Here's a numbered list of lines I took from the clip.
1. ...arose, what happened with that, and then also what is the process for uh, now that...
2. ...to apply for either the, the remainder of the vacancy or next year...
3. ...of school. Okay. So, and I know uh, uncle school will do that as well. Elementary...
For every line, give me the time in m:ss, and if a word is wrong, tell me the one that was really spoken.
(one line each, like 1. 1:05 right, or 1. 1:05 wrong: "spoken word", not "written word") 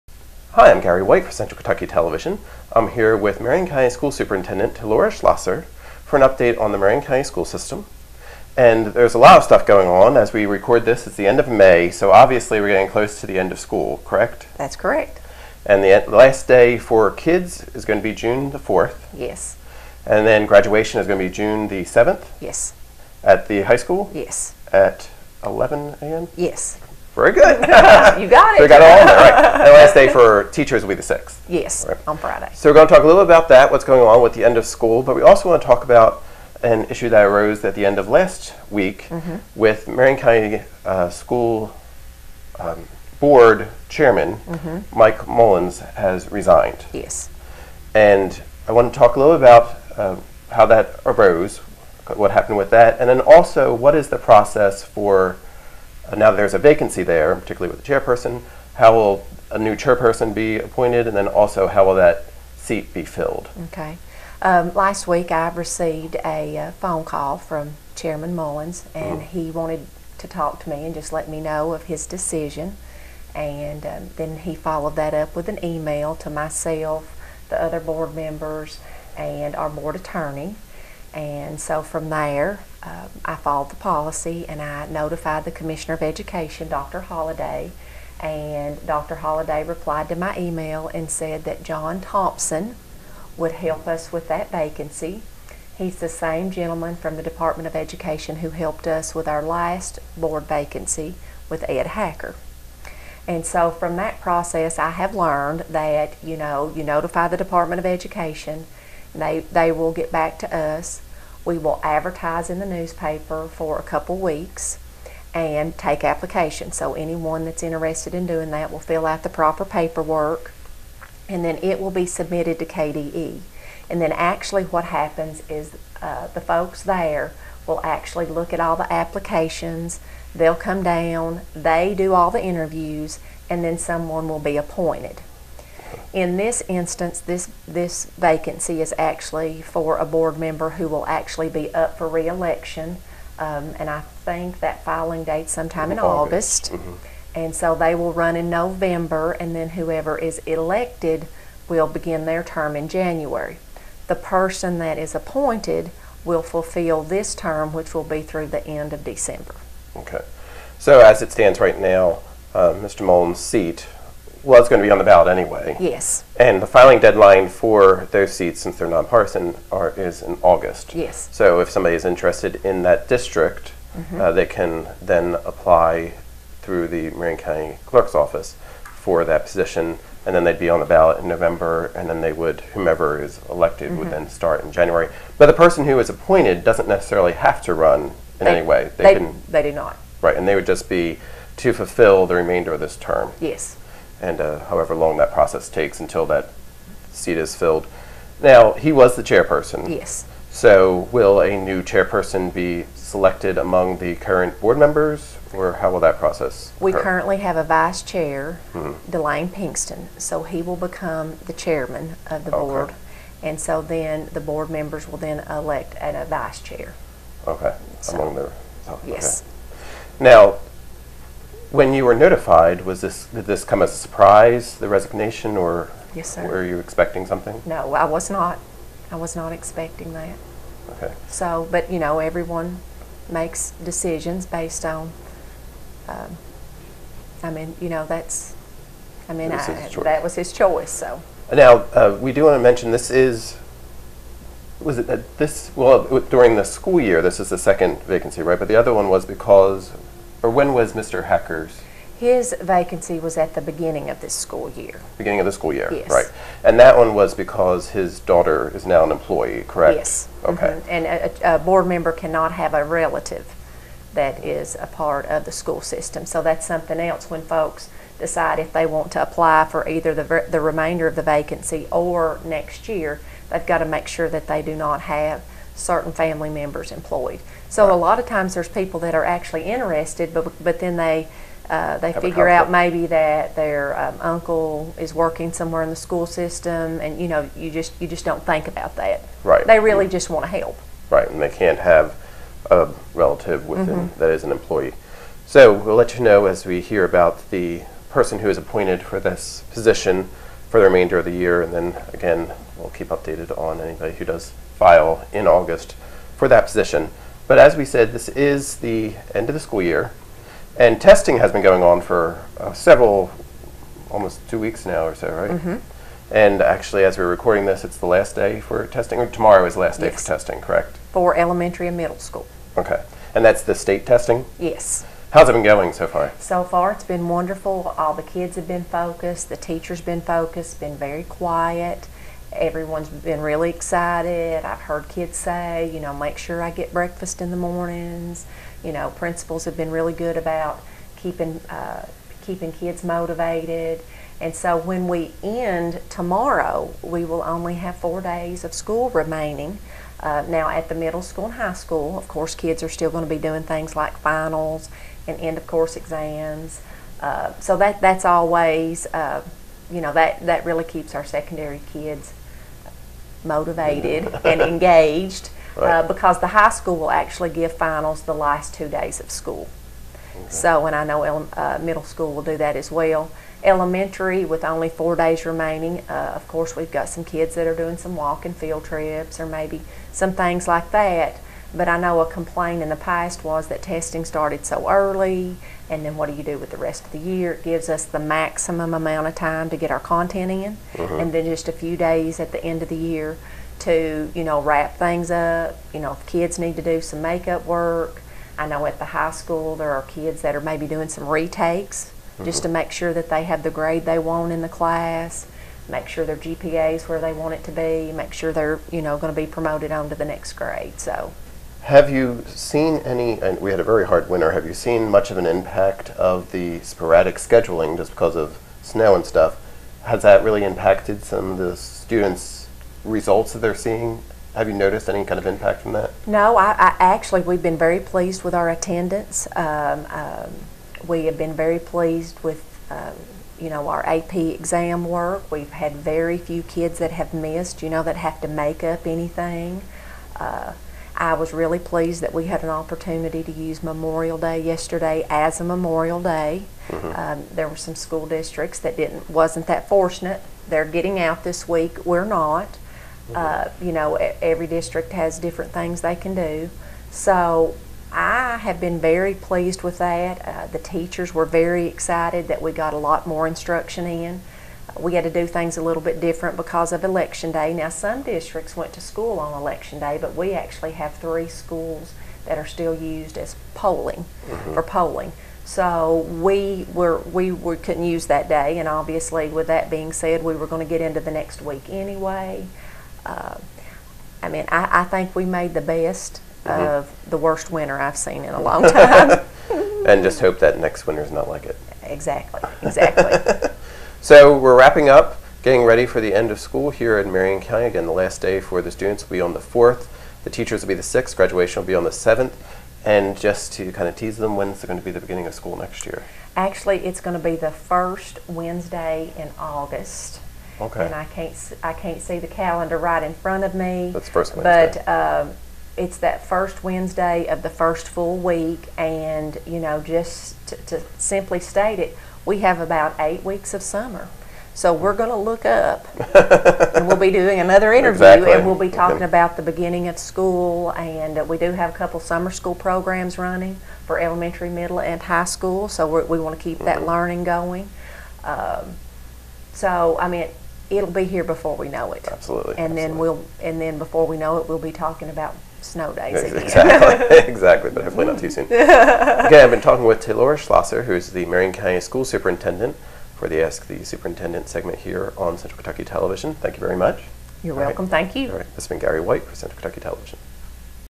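1. 0:51 right
2. 4:29 right
3. 6:09 wrong: "middle", not "uncle".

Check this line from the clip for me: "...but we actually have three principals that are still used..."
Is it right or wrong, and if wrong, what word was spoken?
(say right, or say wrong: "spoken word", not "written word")
wrong: "schools", not "principals".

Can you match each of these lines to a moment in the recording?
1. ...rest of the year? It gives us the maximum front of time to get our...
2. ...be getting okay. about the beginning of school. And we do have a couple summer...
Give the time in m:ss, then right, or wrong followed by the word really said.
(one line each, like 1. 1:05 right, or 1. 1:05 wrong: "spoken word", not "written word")
1. 6:26 wrong: "amount", not "front"
2. 8:48 wrong: "talking", not "getting".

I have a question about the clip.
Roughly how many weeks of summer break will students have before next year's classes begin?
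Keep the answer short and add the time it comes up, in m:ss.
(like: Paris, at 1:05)
8, at 8:43.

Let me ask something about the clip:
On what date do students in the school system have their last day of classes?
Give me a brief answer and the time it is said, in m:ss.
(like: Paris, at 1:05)
June 4, at 0:18.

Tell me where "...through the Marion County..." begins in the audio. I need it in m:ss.
2:56.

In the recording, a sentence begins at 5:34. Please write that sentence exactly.
I've heard kids say, you know, make sure I get breakfast in the mornings.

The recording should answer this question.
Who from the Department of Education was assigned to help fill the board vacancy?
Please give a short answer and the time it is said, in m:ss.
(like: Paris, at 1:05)
John Thompson, at 1:31.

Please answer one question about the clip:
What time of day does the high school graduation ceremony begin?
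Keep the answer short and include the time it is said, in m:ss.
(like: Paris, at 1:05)
11 a.m., at 0:25.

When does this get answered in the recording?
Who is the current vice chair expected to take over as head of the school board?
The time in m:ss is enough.
3:29.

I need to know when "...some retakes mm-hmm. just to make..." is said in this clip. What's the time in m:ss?
6:41.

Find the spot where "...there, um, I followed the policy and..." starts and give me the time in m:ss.
1:22.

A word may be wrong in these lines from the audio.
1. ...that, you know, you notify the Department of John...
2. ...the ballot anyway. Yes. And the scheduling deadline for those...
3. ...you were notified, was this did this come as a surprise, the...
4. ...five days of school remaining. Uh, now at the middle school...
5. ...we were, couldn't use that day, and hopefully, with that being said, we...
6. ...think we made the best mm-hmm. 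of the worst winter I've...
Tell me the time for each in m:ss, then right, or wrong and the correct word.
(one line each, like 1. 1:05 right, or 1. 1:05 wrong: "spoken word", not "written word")
1. 1:45 wrong: "Education", not "John"
2. 2:44 wrong: "filing", not "scheduling"
3. 3:41 right
4. 5:47 wrong: "four", not "five"
5. 7:57 wrong: "obviously", not "hopefully"
6. 8:05 right.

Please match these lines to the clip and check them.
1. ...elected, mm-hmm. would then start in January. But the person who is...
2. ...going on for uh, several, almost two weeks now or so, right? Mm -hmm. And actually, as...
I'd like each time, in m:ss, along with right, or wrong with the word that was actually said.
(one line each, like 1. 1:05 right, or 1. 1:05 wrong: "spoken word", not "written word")
1. 3:03 right
2. 5:11 right.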